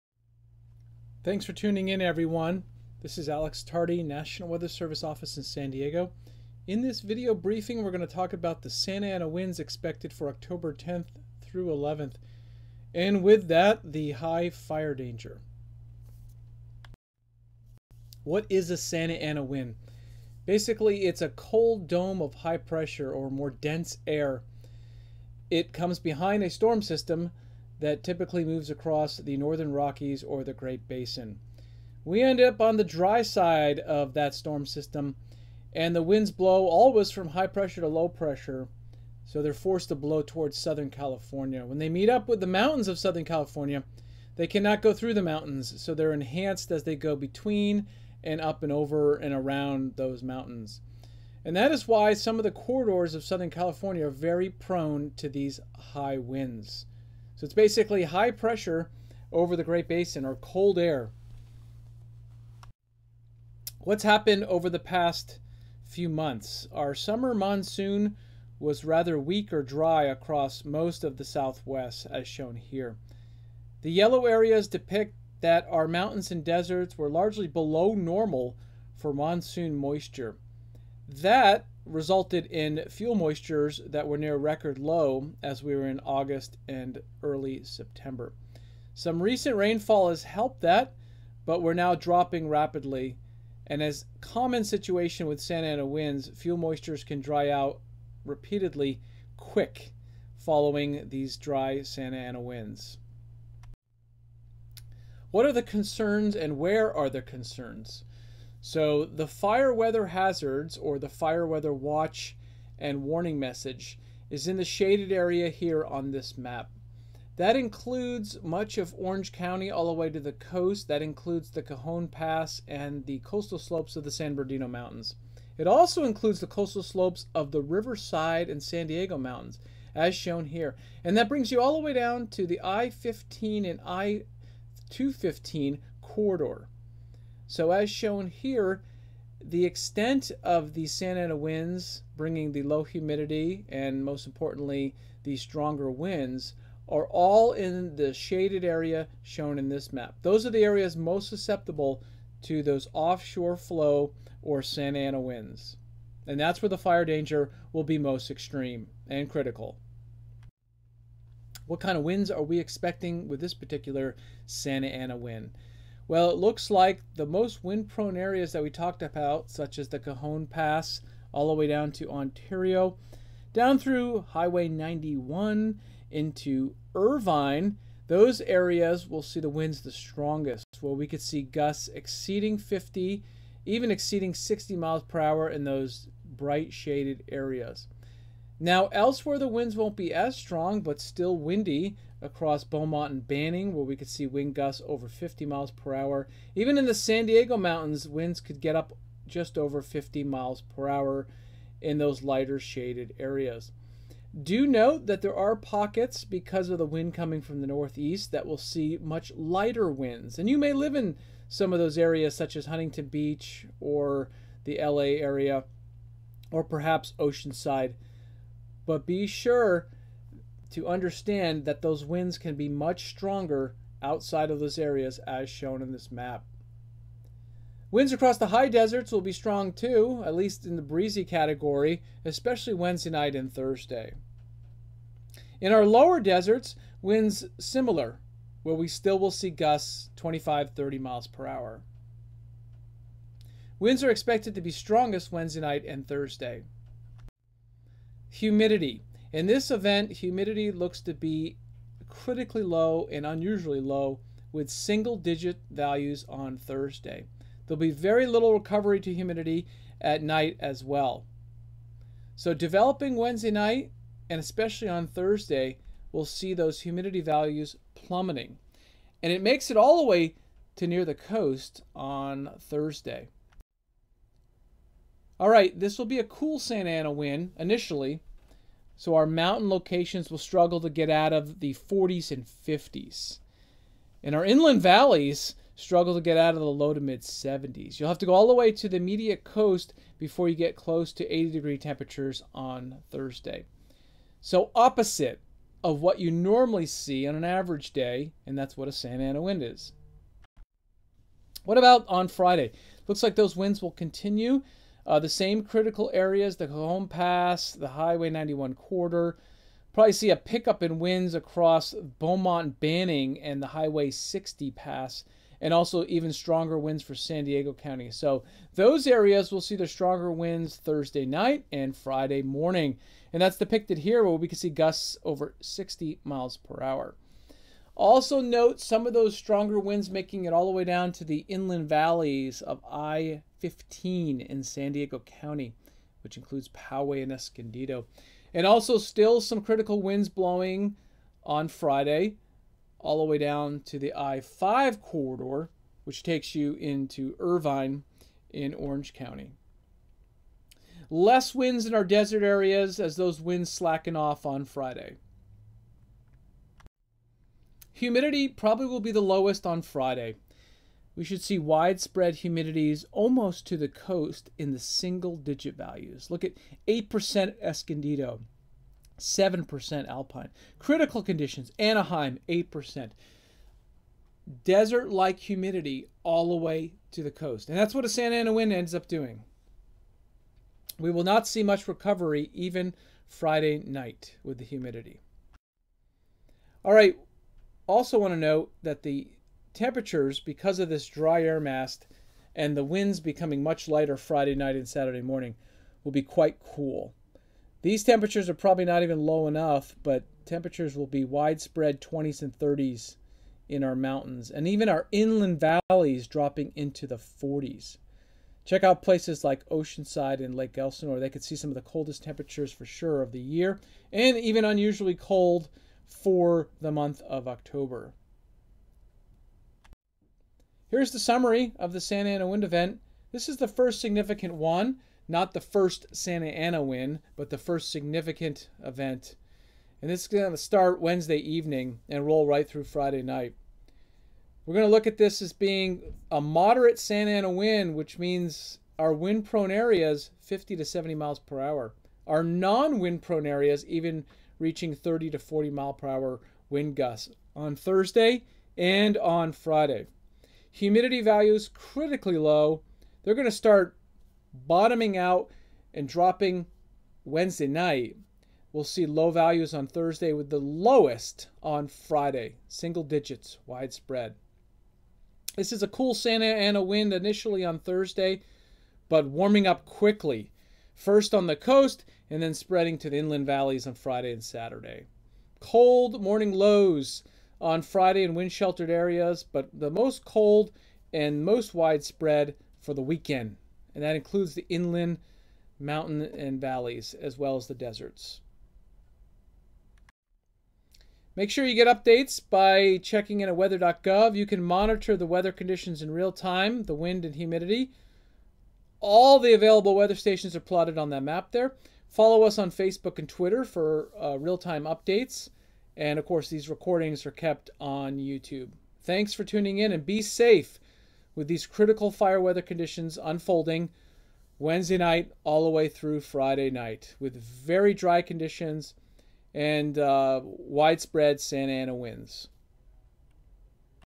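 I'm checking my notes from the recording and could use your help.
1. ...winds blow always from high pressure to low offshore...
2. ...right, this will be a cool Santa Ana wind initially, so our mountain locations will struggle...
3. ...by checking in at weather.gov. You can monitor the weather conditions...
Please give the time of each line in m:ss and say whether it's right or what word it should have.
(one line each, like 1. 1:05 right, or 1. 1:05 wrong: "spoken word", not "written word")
1. 0:36 wrong: "pressure", not "offshore"
2. 4:35 right
3. 8:12 right.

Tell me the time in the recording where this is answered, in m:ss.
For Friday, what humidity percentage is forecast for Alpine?
6:09.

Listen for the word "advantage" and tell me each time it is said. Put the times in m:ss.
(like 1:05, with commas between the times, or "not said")
not said.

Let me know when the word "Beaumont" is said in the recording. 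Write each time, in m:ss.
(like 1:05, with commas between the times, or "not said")
3:12, 5:11.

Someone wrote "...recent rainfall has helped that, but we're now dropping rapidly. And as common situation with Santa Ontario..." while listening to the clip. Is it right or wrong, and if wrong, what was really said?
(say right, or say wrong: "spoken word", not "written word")
wrong: "Ana", not "Ontario".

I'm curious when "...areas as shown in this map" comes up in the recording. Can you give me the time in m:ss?
3:44.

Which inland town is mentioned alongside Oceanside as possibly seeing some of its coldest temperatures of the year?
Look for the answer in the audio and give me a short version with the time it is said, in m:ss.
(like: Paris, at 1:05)
Lake Elsinore, at 6:50.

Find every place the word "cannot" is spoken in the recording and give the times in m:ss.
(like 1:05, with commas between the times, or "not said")
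0:44.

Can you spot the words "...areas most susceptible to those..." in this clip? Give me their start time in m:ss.
2:30.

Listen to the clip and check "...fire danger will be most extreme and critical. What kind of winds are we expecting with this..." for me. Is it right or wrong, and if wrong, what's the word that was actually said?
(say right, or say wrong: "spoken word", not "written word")
right.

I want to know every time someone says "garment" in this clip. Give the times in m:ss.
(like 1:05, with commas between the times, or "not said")
not said.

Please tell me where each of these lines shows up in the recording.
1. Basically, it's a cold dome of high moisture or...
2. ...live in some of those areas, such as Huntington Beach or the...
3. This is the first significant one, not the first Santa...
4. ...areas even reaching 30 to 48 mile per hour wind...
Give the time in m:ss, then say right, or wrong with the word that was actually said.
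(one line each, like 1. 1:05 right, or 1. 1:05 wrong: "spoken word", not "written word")
1. 0:20 wrong: "pressure", not "moisture"
2. 3:30 right
3. 7:03 right
4. 7:23 wrong: "40", not "48".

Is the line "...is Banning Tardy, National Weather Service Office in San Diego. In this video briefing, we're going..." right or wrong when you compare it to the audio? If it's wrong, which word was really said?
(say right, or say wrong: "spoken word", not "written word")
wrong: "Alex", not "Banning".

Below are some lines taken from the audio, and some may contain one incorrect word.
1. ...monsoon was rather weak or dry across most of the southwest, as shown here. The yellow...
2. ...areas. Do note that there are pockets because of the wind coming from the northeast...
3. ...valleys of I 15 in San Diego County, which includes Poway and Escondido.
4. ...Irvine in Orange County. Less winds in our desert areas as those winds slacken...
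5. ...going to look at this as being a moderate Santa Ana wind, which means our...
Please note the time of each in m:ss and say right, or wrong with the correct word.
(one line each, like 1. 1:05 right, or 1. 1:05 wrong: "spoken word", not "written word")
1. 1:07 right
2. 3:23 right
3. 5:31 right
4. 5:47 right
5. 7:14 right.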